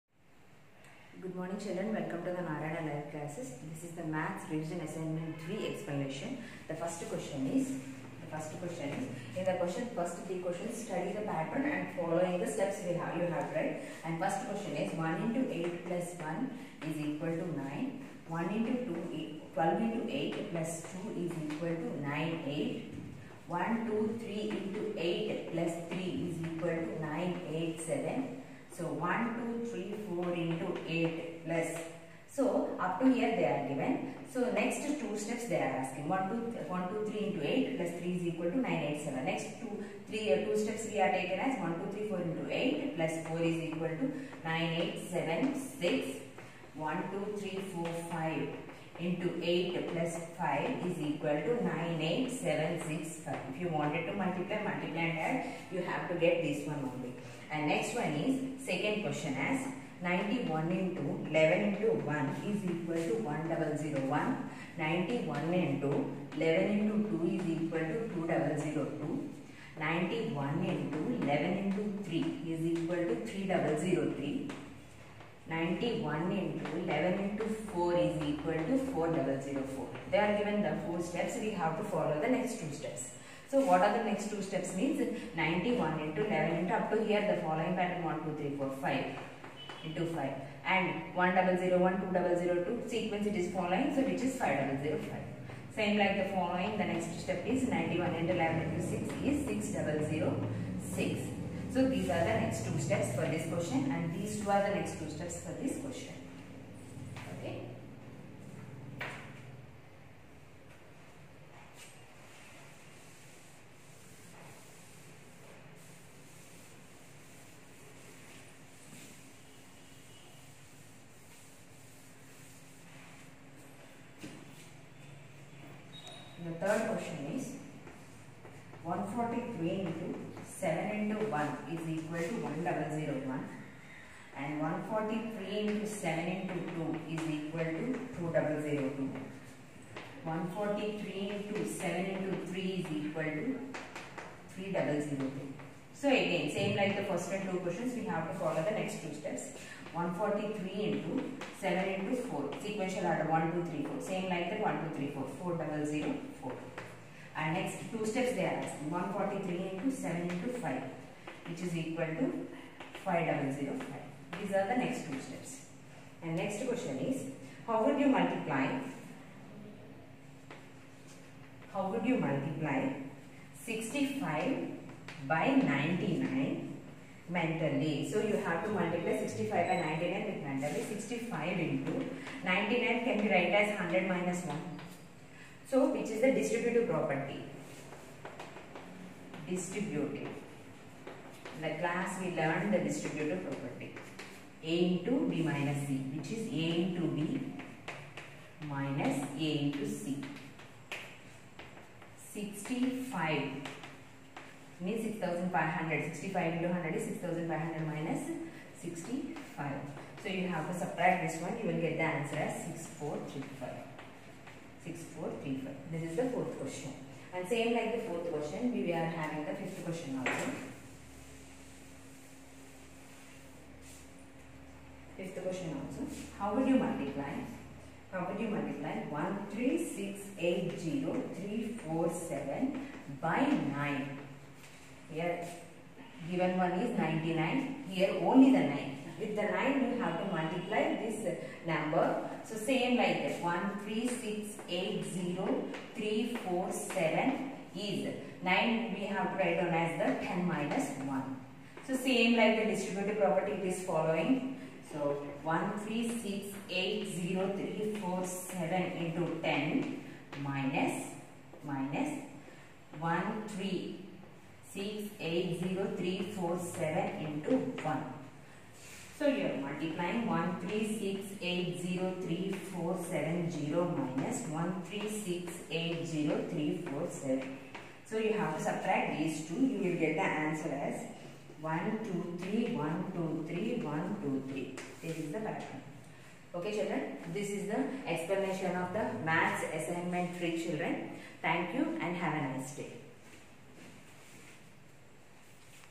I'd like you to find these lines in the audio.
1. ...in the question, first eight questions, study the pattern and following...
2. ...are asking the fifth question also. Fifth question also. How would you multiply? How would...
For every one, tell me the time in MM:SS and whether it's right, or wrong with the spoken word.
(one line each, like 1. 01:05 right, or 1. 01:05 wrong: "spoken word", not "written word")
1. 00:09 wrong: "three", not "eight"
2. 03:38 wrong: "having", not "asking".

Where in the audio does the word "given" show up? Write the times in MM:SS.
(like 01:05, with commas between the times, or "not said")
00:33, 01:20, 03:56.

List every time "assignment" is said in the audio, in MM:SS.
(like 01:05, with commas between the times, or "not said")
00:04, 04:49.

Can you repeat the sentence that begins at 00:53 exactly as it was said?
If you wanted to multiply, multiply and add, you have to get this one only.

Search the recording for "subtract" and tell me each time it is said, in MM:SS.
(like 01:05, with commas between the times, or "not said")
03:30, 04:38.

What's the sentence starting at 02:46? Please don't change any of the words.
And next question is how would you multiply how would you multiply 65 by 99 mentally.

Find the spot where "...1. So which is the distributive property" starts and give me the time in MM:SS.
03:04.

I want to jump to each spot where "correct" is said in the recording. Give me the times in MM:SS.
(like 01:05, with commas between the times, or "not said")
04:45.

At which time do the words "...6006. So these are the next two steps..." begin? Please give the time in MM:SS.
01:39.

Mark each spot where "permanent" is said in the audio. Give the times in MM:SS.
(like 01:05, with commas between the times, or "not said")
not said.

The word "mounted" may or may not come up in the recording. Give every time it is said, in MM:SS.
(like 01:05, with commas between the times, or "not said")
not said.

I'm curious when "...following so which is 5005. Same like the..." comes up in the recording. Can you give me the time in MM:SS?
01:33.